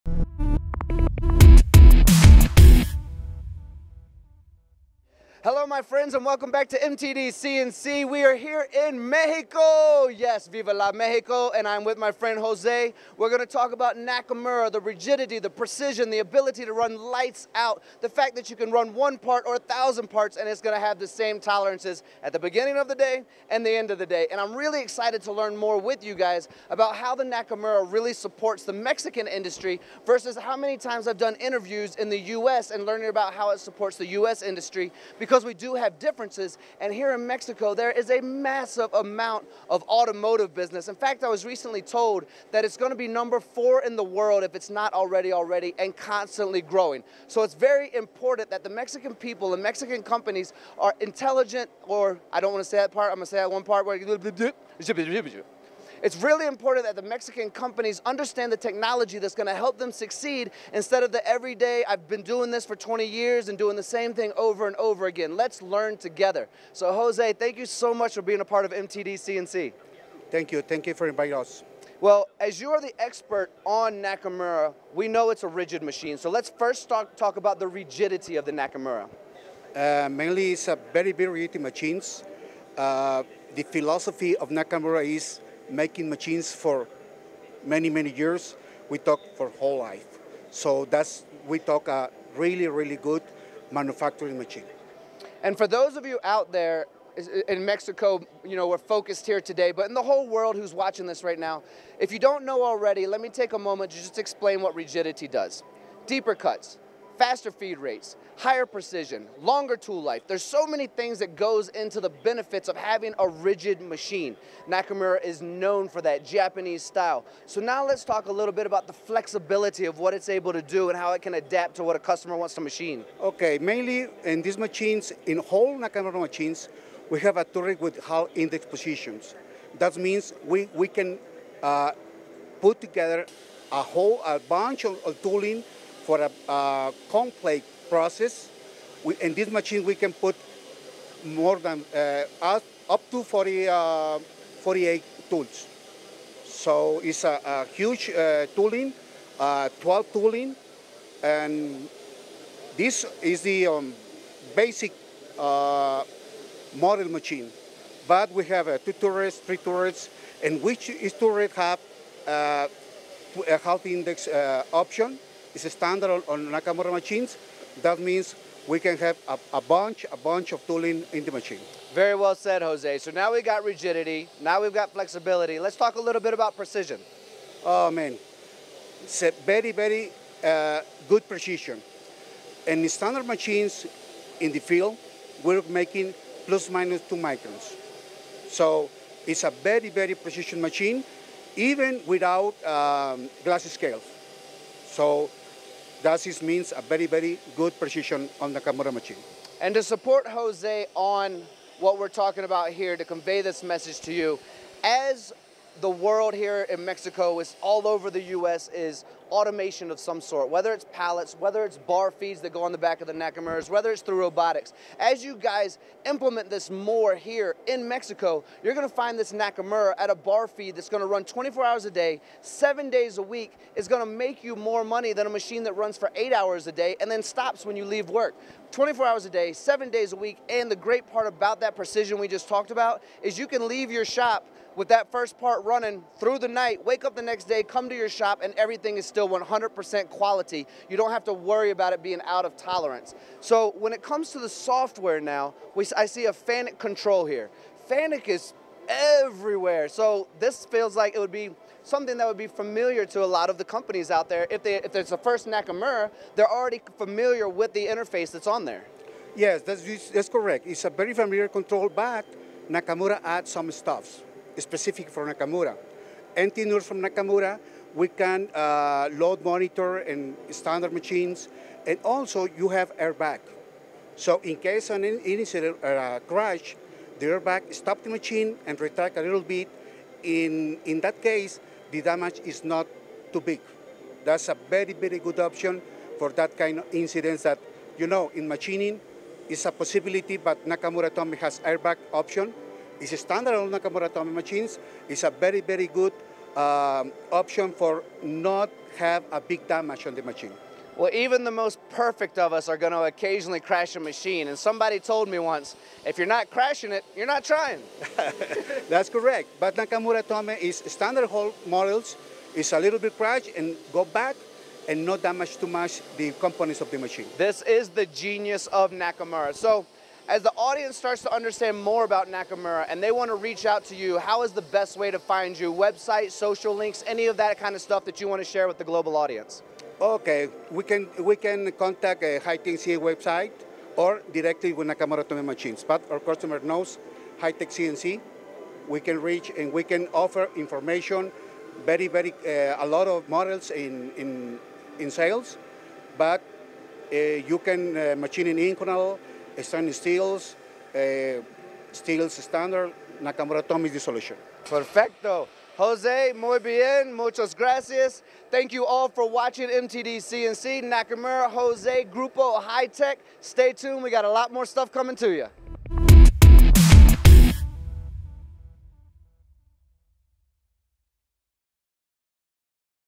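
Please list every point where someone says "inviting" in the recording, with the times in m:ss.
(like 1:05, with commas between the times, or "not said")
1:11.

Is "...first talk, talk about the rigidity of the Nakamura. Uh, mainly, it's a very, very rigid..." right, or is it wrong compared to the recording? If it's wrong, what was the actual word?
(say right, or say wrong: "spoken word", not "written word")
right.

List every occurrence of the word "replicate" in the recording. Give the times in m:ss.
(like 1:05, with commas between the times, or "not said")
not said.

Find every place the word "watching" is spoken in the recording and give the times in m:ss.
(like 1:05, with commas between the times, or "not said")
1:40, 5:59.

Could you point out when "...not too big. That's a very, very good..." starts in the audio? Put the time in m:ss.
4:42.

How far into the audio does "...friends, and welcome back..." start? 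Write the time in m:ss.
0:05.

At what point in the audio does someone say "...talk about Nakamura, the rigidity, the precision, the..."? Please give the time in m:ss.
0:13.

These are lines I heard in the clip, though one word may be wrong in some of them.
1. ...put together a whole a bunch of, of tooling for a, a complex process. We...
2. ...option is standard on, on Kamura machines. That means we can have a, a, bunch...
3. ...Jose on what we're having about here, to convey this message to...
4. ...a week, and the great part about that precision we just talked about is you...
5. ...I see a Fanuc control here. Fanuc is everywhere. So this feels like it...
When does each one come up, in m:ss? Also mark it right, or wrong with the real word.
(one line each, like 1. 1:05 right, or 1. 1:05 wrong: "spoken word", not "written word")
1. 2:12 right
2. 2:44 wrong: "Nakamura", not "Kamura"
3. 3:20 wrong: "talking", not "having"
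4. 3:50 right
5. 4:05 right.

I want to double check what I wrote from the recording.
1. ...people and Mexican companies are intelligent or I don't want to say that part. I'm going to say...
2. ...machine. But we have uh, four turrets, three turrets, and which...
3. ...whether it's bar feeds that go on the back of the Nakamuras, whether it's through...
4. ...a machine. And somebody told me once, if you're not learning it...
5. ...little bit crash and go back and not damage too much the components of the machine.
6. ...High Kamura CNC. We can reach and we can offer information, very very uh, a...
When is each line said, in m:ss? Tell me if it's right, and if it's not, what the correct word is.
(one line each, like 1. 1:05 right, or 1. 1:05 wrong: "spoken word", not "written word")
1. 0:49 right
2. 2:37 wrong: "two", not "four"
3. 3:31 right
4. 5:03 wrong: "crashing", not "learning"
5. 5:12 right
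6. 5:37 wrong: "Tech", not "Kamura".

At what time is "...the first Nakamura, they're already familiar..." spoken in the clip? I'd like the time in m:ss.
4:15.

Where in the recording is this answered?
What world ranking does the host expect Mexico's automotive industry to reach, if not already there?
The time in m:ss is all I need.
0:43.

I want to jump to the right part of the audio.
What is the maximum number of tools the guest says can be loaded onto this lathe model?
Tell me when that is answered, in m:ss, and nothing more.
2:24.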